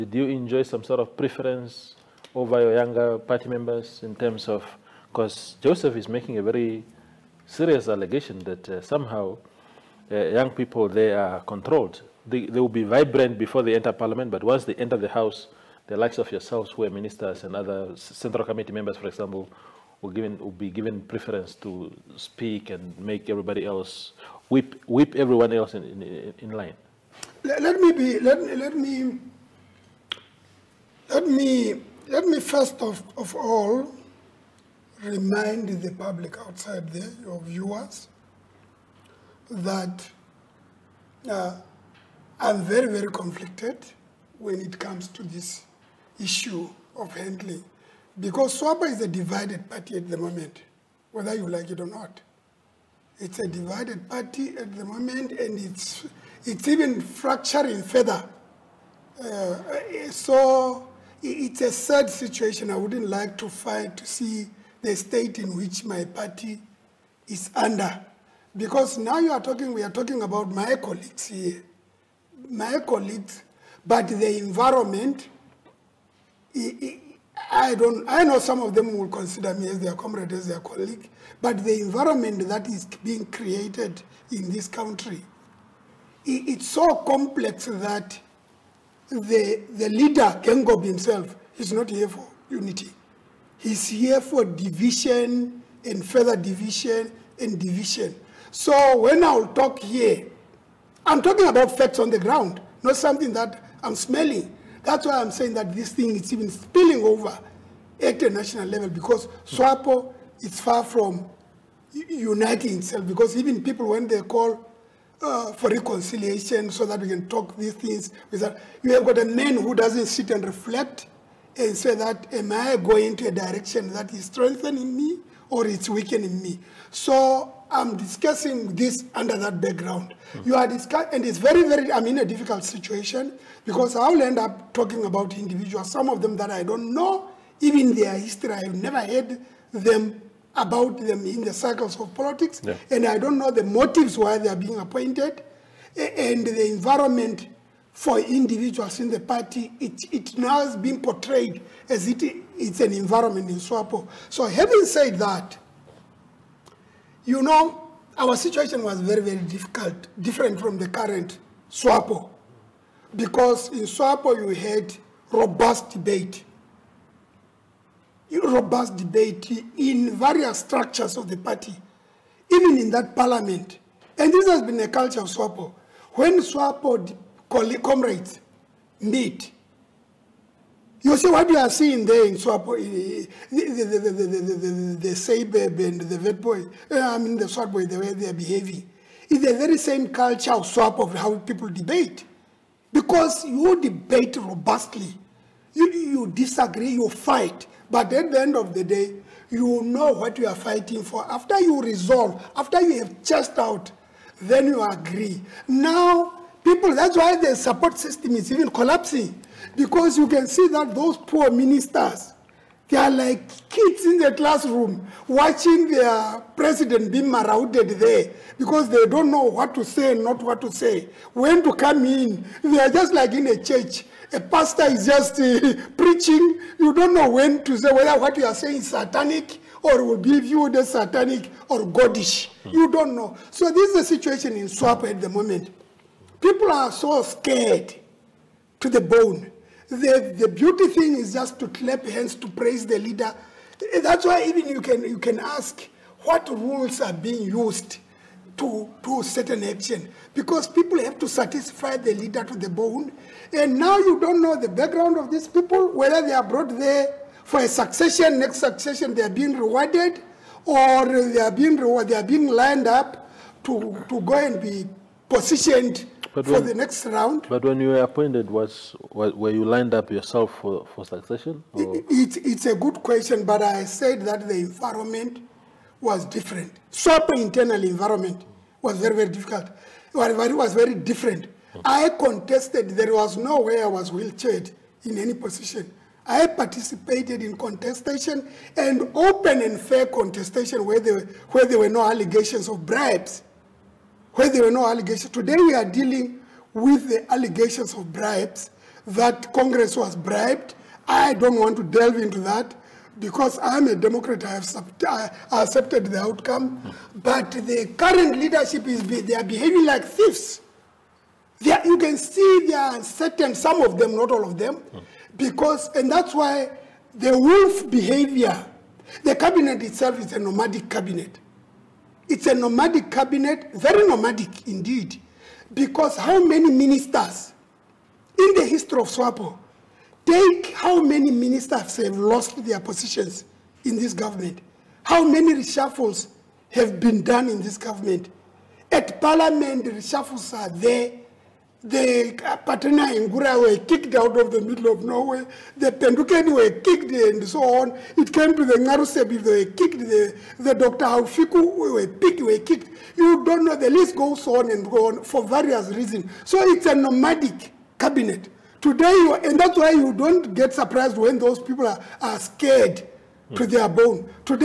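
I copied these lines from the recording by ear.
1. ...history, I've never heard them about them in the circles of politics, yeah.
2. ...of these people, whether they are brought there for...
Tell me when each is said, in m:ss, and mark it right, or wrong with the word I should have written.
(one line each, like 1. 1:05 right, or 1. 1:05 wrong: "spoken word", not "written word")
1. 2:18 right
2. 4:15 right.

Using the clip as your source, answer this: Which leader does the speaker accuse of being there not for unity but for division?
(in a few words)
Geingob.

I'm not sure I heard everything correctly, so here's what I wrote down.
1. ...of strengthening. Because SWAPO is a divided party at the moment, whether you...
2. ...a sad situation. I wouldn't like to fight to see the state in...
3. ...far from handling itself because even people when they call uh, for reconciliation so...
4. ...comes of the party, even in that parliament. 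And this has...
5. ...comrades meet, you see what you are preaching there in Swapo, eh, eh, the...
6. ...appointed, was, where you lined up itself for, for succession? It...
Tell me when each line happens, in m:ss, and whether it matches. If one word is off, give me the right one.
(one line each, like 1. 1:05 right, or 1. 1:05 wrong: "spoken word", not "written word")
1. 0:46 wrong: "handling", not "strengthening"
2. 1:01 right
3. 1:50 wrong: "uniting", not "handling"
4. 2:50 wrong: "structures", not "comes"
5. 2:57 wrong: "seeing", not "preaching"
6. 4:28 wrong: "yourself", not "itself".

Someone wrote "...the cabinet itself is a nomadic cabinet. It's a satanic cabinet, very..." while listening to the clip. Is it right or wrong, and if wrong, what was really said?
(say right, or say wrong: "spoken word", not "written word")
wrong: "nomadic", not "satanic".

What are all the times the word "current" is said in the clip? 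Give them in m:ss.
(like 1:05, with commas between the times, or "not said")
2:40, 5:07.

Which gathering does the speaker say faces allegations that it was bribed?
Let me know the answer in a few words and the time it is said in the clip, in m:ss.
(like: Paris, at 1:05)
Congress, at 4:59.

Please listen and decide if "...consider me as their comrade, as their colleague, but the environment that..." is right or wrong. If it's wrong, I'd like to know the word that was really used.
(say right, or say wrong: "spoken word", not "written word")
right.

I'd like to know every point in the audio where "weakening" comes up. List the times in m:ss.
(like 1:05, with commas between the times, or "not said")
2:05.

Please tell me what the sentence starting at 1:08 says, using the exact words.
Because now you are talking, we are talking about my colleagues here.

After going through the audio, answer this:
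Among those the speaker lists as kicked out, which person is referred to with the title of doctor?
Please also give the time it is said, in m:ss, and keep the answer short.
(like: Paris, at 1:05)
Dr. Haufiku, at 5:50.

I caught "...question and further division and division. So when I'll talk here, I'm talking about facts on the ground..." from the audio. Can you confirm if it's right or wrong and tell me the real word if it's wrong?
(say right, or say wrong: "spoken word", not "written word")
wrong: "division", not "question".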